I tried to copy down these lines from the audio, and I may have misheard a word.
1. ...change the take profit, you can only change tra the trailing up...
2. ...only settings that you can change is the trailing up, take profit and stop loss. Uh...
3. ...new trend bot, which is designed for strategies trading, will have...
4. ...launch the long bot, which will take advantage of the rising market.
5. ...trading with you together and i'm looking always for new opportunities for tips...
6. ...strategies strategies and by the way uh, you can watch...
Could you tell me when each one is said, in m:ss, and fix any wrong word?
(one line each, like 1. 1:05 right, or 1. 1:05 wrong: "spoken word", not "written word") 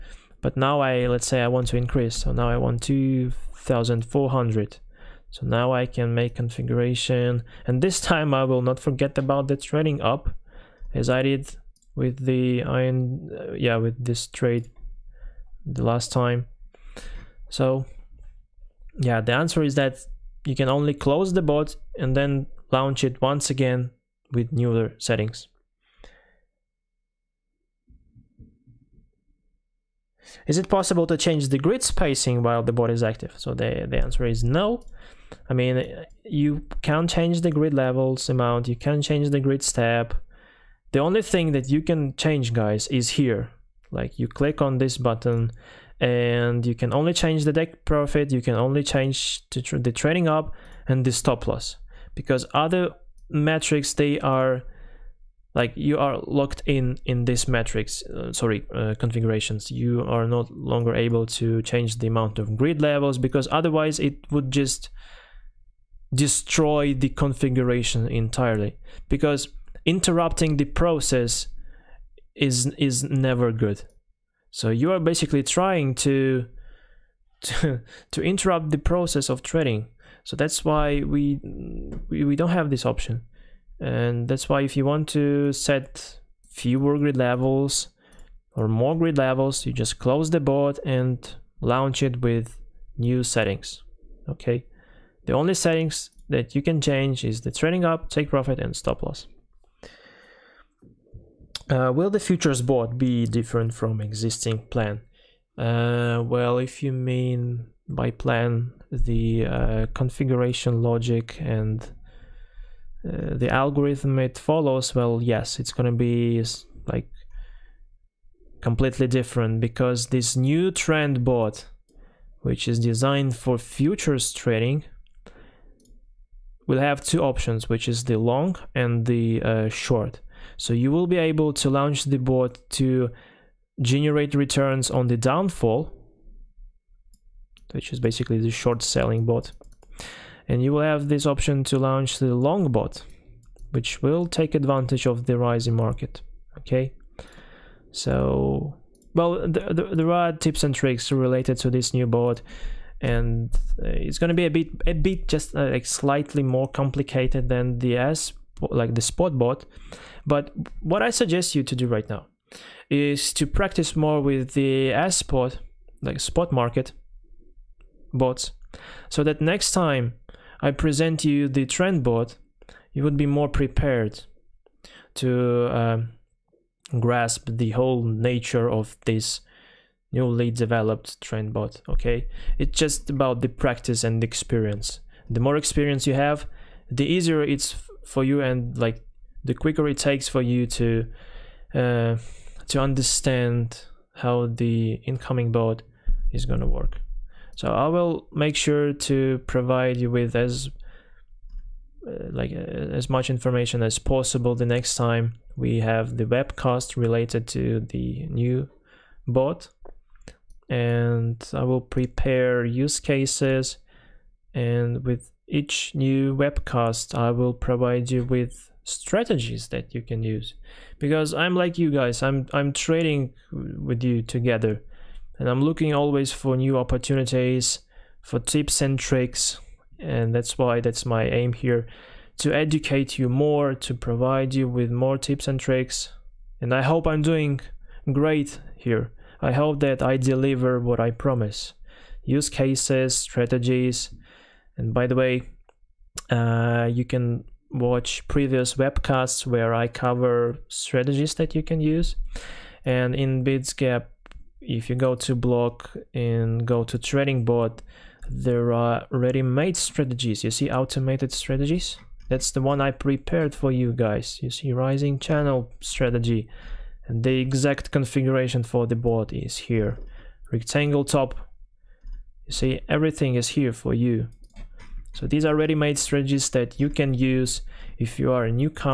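1. 0:47 right
2. 1:35 right
3. 2:00 wrong: "futures", not "strategies"
4. 2:21 right
5. 3:42 right
6. 4:02 wrong: "cases", not "strategies".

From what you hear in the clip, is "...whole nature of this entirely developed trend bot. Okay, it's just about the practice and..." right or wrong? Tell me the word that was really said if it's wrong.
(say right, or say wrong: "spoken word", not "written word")
wrong: "newly", not "entirely".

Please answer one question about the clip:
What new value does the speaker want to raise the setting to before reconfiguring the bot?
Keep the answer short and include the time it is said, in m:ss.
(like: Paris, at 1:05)
2400, at 0:02.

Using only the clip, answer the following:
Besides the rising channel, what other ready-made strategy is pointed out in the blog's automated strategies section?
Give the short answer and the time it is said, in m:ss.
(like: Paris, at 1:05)
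Rectangle top, at 4:30.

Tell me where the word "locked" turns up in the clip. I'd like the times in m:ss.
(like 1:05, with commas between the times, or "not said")
0:56.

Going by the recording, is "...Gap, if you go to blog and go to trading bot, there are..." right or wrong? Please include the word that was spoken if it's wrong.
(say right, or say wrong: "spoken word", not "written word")
right.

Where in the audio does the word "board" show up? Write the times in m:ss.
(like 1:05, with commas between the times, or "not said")
1:30, 4:28.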